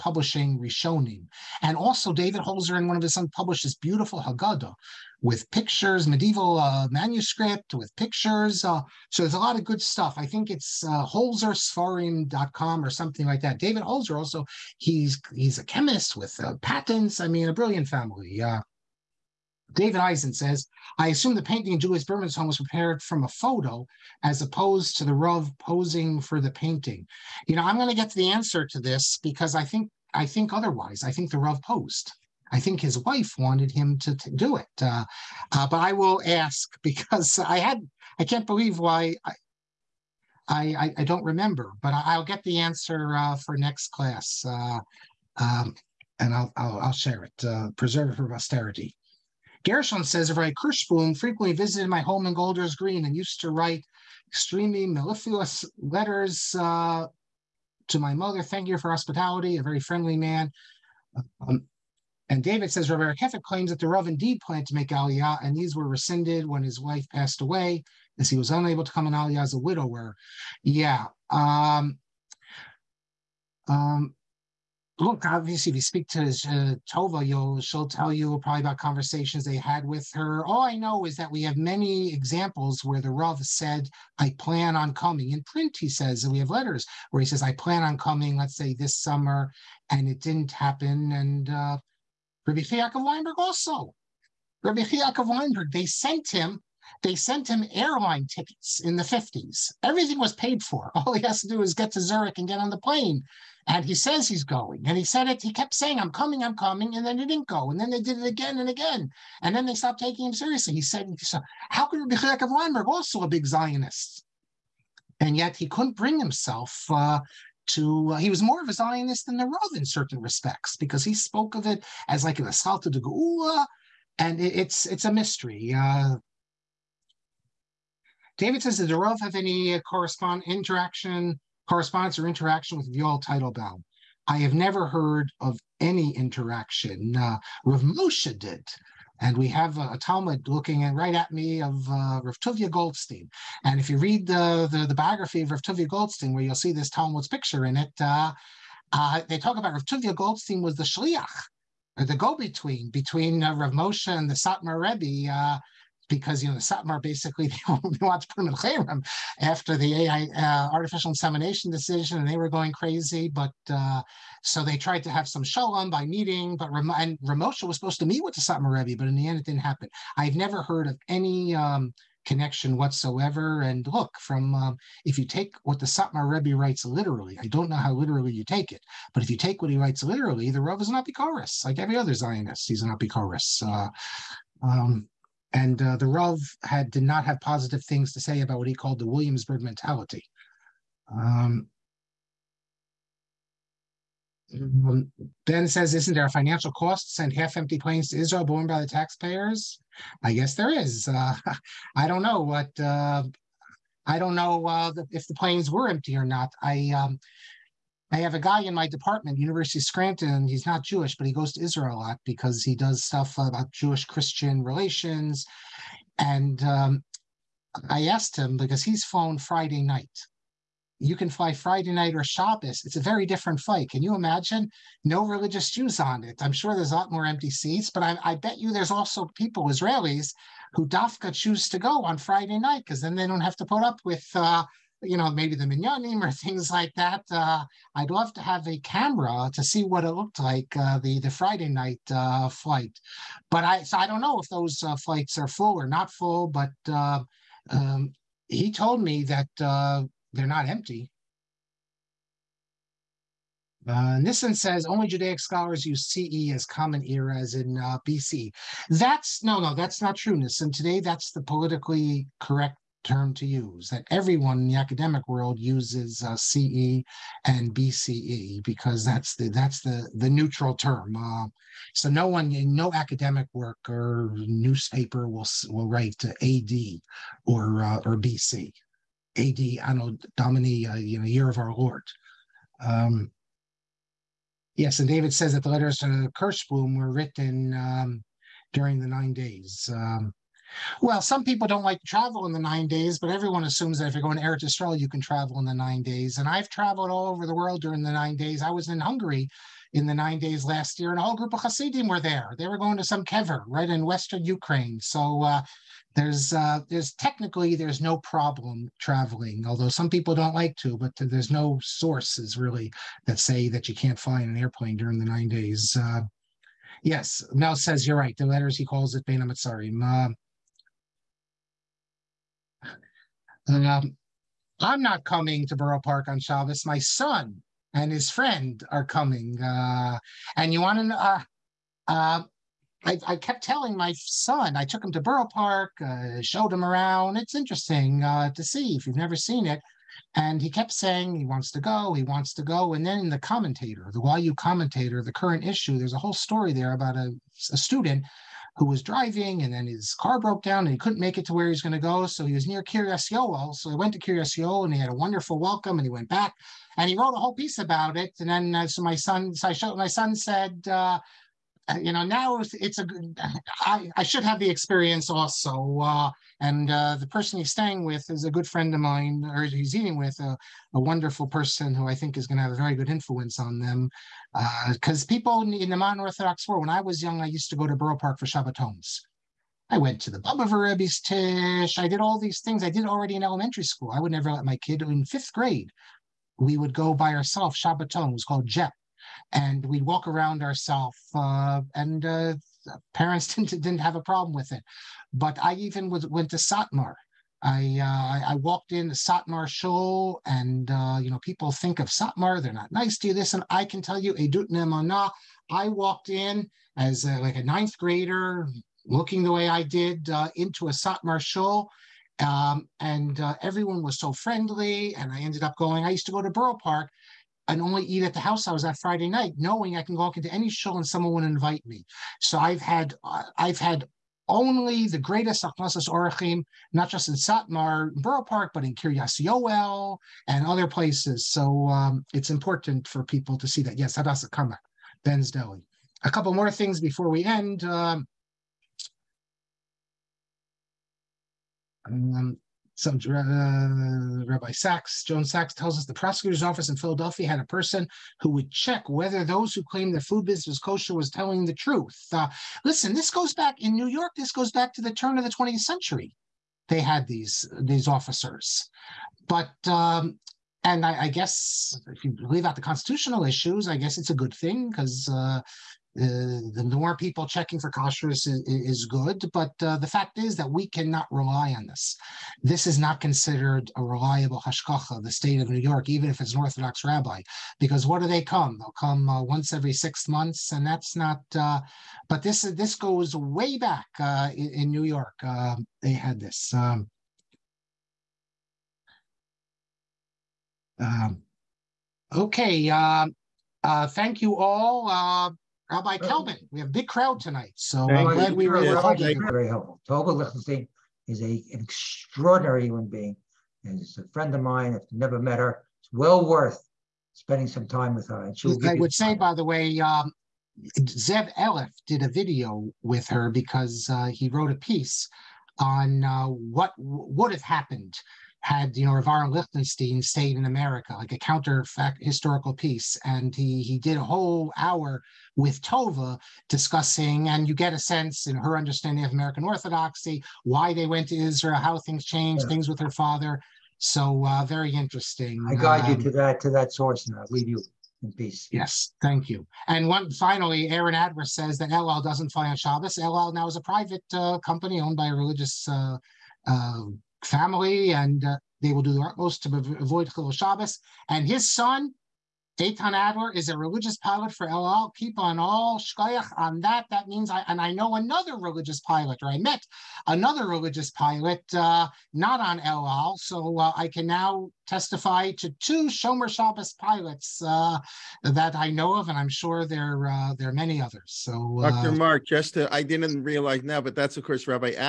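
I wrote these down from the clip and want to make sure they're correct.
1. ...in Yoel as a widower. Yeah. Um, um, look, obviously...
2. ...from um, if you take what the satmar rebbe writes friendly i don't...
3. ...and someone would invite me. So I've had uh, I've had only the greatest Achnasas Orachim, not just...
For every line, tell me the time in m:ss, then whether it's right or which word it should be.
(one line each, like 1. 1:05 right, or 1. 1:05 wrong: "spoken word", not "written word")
1. 1:09 wrong: "Aliyah", not "Yoel"
2. 2:54 wrong: "literally", not "friendly"
3. 7:00 right.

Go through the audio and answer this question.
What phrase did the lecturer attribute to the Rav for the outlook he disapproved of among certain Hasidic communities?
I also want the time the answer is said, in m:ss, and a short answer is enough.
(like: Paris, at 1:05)
Williamsburg mentality, at 3:09.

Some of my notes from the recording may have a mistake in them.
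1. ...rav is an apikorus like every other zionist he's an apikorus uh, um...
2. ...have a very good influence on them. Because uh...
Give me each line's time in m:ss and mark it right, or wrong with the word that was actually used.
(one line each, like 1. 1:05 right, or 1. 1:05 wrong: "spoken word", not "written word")
1. 3:00 right
2. 6:12 right.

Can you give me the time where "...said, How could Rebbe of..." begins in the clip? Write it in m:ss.
1:50.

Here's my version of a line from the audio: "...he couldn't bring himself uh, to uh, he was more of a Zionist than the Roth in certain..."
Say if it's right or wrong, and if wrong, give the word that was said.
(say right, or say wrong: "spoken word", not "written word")
right.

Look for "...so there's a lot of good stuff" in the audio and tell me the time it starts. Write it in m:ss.
0:09.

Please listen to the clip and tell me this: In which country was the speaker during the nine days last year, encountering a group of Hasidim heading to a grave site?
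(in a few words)
Hungary.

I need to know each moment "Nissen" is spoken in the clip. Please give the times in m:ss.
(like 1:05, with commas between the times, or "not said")
4:14, 4:20.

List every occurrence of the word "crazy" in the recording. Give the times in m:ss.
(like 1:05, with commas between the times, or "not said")
2:42.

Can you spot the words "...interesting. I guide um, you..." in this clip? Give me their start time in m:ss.
8:54.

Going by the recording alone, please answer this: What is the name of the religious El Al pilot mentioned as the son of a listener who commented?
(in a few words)
Dayton Adler.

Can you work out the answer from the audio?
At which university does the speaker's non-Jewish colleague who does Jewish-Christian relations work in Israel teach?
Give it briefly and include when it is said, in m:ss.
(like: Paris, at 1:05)
University of Scranton, at 3:29.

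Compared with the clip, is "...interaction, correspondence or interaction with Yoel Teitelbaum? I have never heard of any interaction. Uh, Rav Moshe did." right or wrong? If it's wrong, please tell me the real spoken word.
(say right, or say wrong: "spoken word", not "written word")
right.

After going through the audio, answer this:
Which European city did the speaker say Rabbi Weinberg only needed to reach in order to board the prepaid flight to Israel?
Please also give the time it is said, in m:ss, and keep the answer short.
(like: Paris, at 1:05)
Zurich, at 1:42.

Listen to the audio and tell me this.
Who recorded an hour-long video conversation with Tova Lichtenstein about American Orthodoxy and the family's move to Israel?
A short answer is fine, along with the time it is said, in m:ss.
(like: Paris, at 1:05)
Zev Eleff, at 8:30.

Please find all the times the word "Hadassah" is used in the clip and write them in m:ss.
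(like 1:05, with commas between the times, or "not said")
7:14.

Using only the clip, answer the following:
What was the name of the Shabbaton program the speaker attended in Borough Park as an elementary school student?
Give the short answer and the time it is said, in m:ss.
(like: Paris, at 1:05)
JEP, at 6:28.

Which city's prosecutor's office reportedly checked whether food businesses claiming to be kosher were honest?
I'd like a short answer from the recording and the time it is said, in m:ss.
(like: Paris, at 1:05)
Philadelphia, at 7:26.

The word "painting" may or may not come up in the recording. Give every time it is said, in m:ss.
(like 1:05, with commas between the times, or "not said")
0:21, 0:26.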